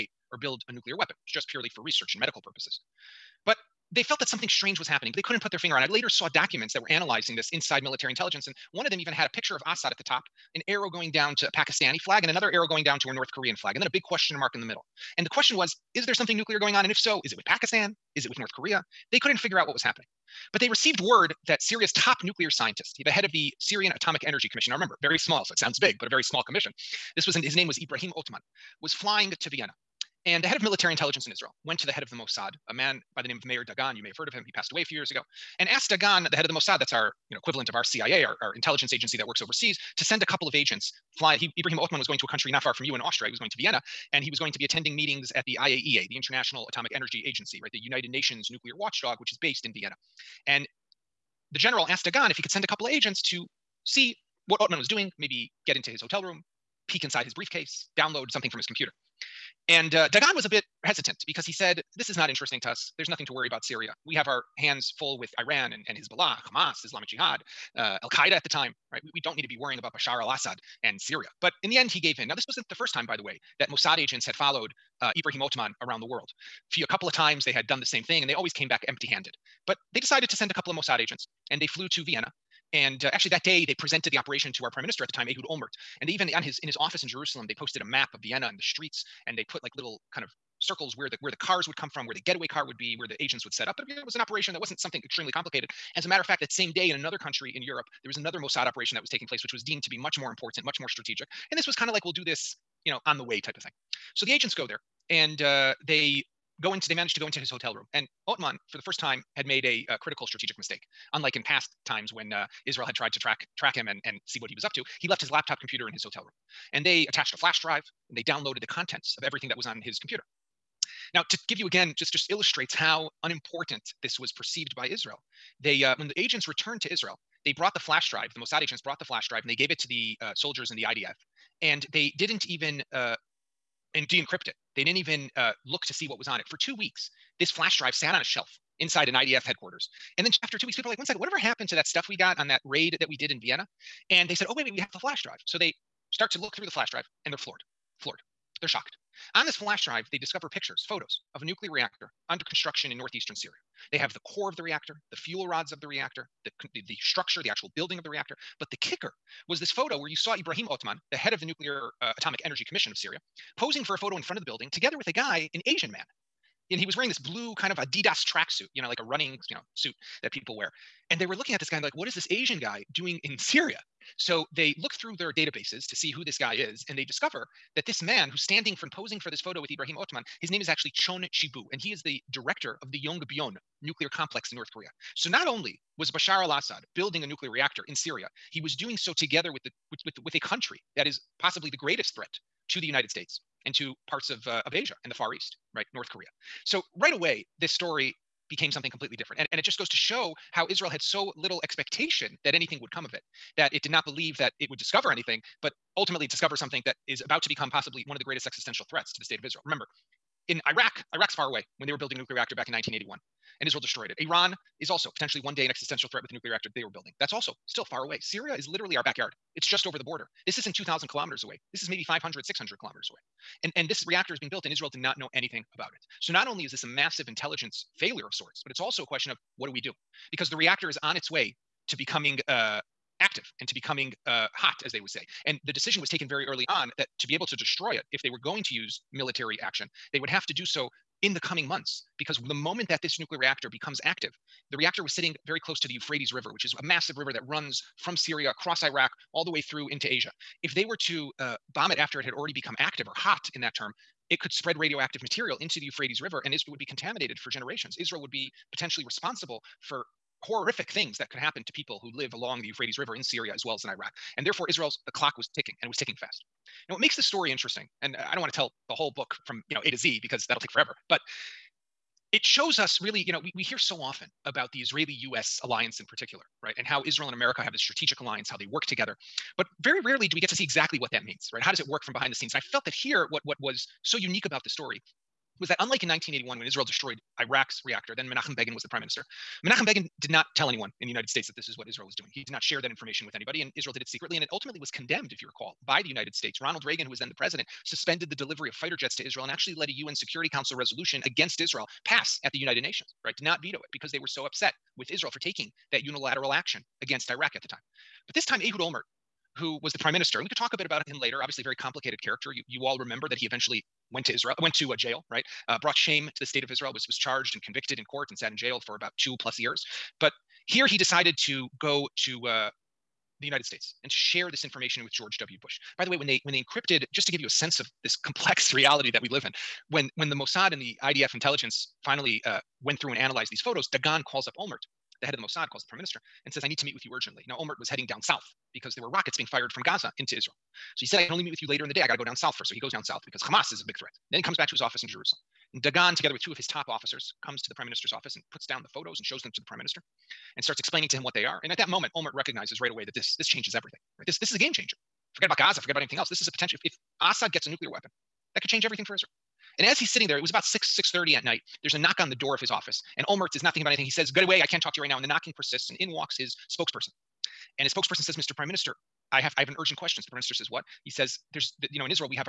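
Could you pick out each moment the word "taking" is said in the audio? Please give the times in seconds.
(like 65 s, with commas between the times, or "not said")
99 s, 305 s.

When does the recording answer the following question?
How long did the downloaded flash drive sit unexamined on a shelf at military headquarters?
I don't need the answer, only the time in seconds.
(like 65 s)
136 s.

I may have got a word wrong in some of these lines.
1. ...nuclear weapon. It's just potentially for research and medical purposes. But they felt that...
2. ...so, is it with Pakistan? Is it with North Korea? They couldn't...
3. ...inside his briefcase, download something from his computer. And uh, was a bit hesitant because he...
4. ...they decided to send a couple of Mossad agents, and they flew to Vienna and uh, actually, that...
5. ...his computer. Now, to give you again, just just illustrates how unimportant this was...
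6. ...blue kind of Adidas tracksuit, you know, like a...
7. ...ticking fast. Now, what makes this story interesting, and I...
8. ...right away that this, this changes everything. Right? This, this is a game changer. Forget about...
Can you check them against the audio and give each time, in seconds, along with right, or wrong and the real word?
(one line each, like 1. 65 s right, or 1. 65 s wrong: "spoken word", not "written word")
1. 0 s wrong: "purely", not "potentially"
2. 16 s right
3. 57 s right
4. 79 s right
5. 119 s right
6. 167 s right
7. 265 s right
8. 352 s right.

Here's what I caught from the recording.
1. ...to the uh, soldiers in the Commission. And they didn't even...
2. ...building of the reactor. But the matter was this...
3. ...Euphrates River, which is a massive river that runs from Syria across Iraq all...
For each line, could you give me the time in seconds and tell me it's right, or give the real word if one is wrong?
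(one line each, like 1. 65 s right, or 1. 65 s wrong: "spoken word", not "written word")
1. 129 s wrong: "IDF", not "Commission"
2. 157 s wrong: "kicker", not "matter"
3. 245 s right.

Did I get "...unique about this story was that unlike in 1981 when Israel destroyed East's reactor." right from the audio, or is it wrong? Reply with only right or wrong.
wrong.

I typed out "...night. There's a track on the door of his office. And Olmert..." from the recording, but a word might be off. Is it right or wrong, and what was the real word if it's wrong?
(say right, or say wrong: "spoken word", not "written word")
wrong: "knock", not "track".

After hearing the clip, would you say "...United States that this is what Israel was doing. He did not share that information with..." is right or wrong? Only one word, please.
right.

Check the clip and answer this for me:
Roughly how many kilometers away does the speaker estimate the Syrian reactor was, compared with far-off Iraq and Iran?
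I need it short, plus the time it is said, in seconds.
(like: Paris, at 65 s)
500 to 600, at 222 s.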